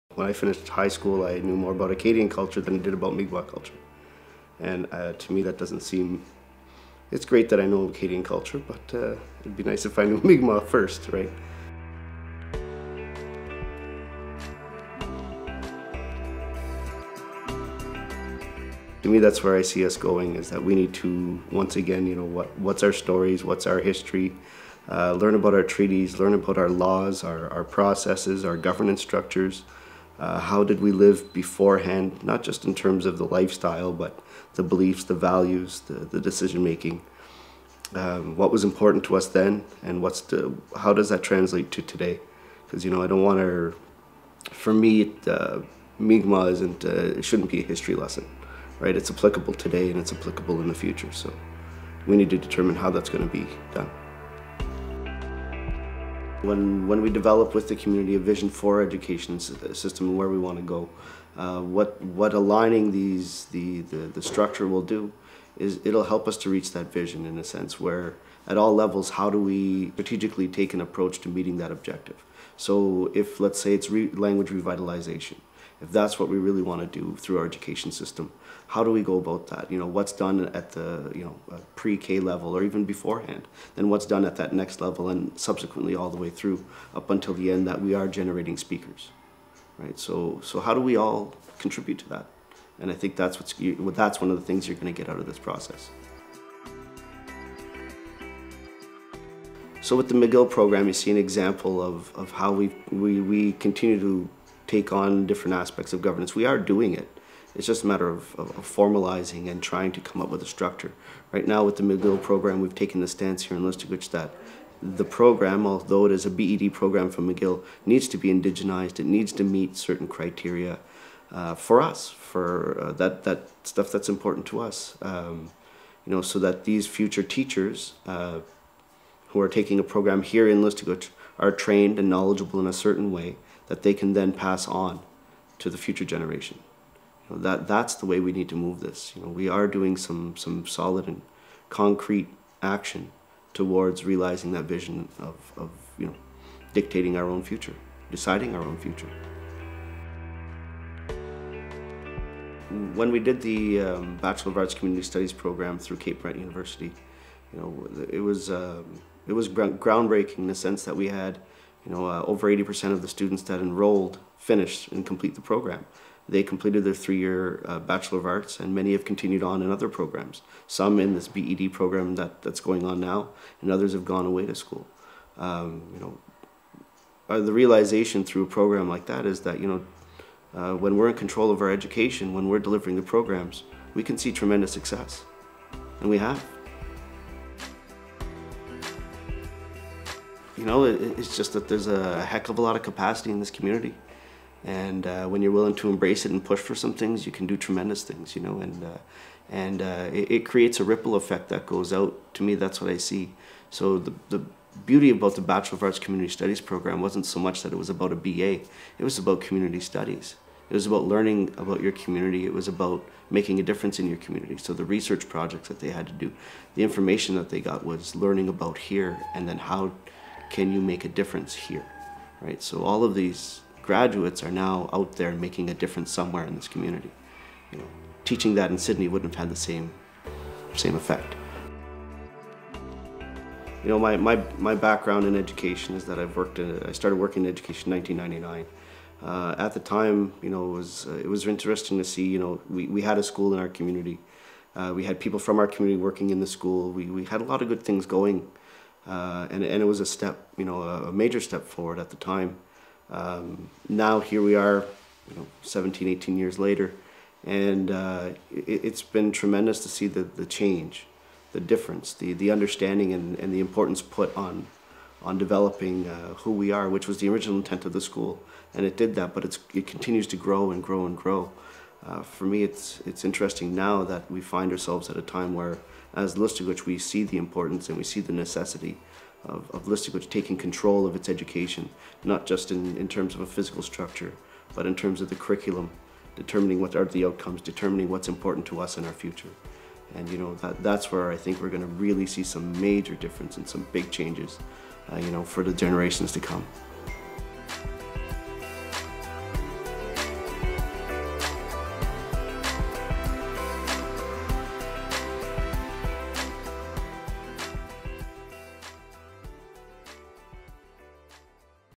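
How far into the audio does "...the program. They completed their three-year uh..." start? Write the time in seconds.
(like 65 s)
165 s.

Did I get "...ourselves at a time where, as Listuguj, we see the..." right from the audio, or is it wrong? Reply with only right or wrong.
right.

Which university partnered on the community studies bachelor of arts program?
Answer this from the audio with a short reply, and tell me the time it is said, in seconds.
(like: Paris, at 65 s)
Cape Breton University, at 155 s.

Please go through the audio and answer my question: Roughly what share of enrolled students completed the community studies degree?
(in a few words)
over 80%.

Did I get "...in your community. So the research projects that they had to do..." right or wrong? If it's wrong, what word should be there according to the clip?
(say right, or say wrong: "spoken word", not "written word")
right.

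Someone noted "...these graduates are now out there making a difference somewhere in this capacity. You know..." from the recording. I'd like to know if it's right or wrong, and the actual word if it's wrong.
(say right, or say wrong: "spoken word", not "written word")
wrong: "community", not "capacity".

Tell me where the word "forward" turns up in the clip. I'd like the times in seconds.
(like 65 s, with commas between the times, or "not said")
251 s.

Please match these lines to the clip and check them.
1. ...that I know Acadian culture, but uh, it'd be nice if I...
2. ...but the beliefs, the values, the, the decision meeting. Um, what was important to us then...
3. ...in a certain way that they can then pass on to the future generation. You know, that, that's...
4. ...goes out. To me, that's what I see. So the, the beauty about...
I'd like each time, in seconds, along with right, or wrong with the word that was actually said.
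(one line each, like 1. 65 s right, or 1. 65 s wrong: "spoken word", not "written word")
1. 7 s right
2. 33 s wrong: "making", not "meeting"
3. 132 s right
4. 201 s right.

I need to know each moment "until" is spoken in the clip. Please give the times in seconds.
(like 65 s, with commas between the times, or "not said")
87 s.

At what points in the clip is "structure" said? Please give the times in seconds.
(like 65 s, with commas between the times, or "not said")
29 s, 64 s, 110 s, 283 s.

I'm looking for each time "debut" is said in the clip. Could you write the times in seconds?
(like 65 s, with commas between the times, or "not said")
not said.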